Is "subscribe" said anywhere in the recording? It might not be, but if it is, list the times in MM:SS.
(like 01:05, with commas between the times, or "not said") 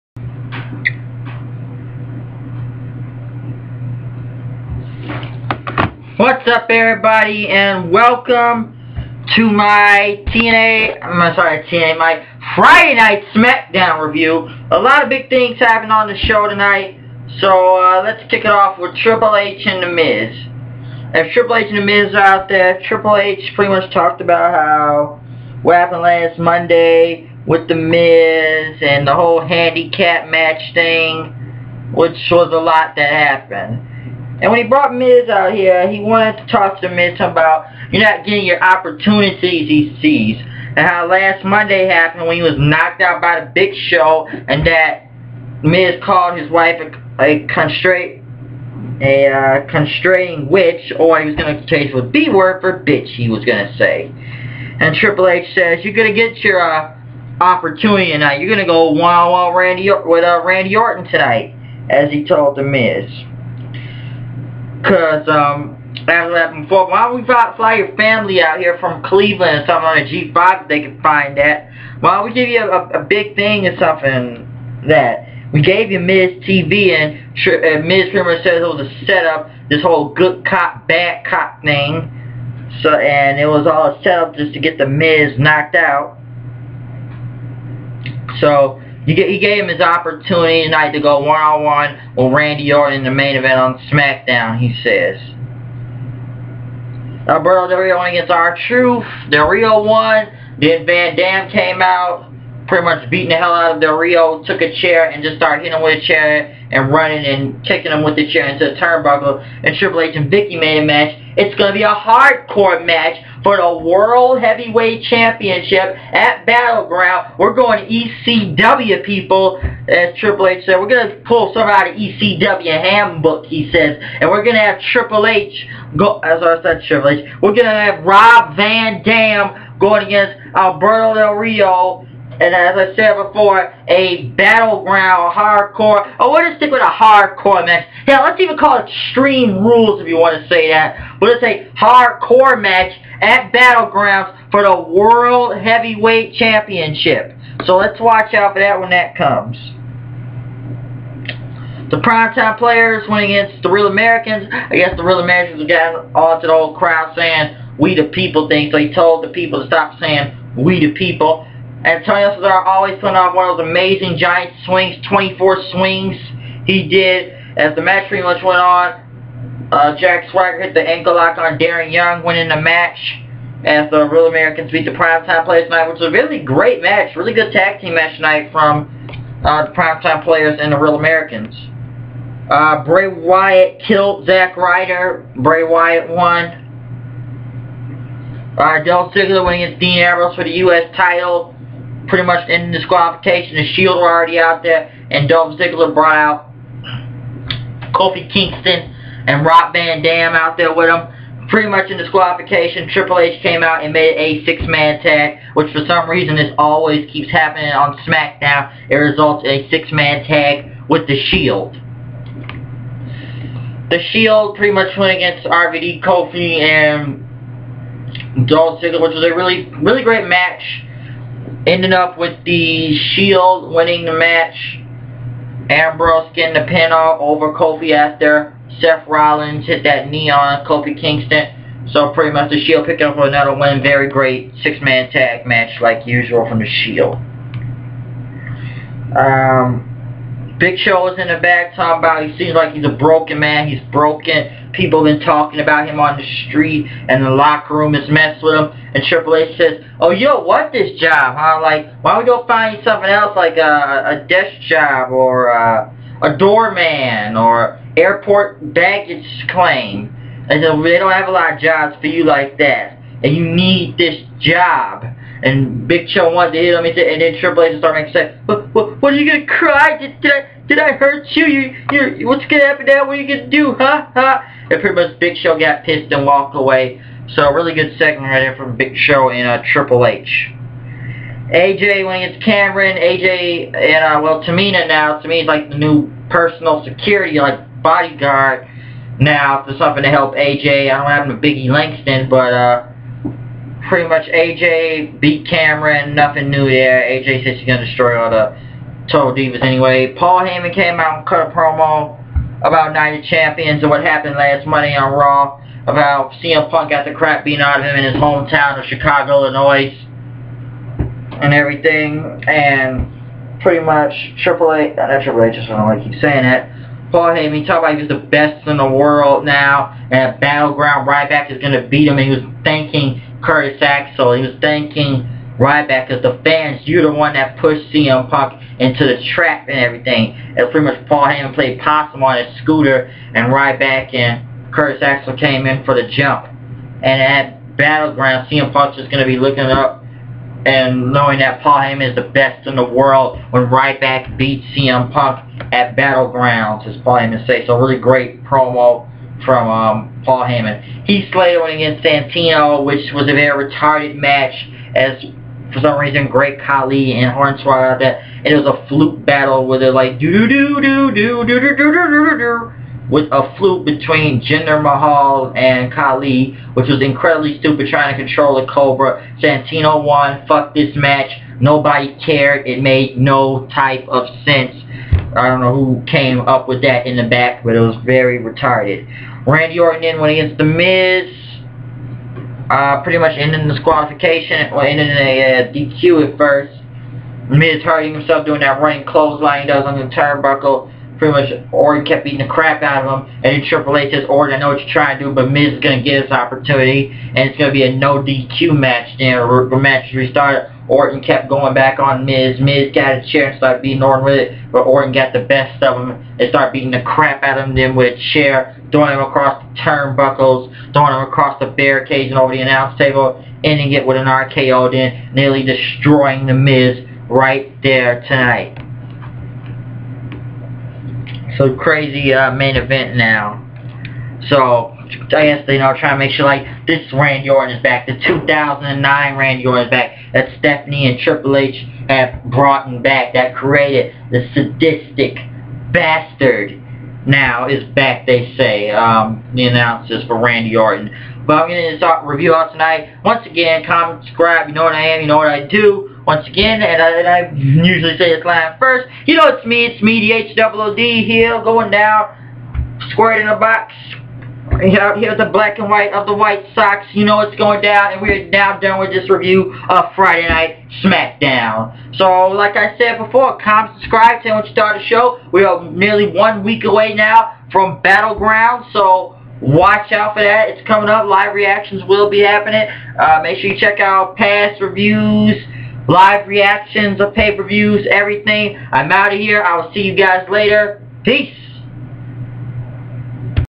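07:24, 07:43.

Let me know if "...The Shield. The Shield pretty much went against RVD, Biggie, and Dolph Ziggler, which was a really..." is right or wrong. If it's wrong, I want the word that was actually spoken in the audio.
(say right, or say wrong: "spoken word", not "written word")
wrong: "Kofi", not "Biggie".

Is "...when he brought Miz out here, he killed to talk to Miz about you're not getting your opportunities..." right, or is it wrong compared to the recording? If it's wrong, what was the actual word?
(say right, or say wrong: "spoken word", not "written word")
wrong: "wanted", not "killed".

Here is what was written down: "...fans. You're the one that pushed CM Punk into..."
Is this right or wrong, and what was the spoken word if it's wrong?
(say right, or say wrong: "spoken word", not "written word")
right.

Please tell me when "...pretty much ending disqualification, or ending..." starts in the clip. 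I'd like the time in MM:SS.
06:23.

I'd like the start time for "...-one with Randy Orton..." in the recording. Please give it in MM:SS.
01:32.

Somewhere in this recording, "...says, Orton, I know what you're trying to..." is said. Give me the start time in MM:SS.
06:34.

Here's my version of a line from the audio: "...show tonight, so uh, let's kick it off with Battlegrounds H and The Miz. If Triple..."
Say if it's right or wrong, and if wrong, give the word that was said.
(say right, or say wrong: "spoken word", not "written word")
wrong: "Triple", not "Battlegrounds".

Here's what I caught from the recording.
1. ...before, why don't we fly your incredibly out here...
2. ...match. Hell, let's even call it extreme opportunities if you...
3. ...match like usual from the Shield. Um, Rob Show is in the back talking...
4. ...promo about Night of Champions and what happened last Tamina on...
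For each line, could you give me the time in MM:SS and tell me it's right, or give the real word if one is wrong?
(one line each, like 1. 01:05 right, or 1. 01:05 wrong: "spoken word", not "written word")
1. 01:06 wrong: "family", not "incredibly"
2. 02:17 wrong: "rules", not "opportunities"
3. 03:55 wrong: "Big", not "Rob"
4. 05:01 wrong: "Monday", not "Tamina".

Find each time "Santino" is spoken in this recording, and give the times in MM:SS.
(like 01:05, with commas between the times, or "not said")
05:52, 06:09.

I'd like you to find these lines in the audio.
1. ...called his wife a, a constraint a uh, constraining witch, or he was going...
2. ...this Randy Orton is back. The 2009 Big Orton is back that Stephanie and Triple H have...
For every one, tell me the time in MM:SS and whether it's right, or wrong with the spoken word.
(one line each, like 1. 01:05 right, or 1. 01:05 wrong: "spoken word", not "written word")
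1. 00:46 right
2. 07:06 wrong: "Randy", not "Big".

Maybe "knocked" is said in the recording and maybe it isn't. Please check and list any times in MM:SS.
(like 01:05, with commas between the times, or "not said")
00:42, 01:25.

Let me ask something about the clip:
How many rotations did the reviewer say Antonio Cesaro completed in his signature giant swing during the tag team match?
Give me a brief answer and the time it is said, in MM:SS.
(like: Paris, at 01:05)
24, at 02:45.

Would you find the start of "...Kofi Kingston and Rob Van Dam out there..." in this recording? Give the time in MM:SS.
03:17.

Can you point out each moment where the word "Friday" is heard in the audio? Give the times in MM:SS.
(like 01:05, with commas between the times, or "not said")
00:12, 07:40.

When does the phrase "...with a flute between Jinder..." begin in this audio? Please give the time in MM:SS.
06:03.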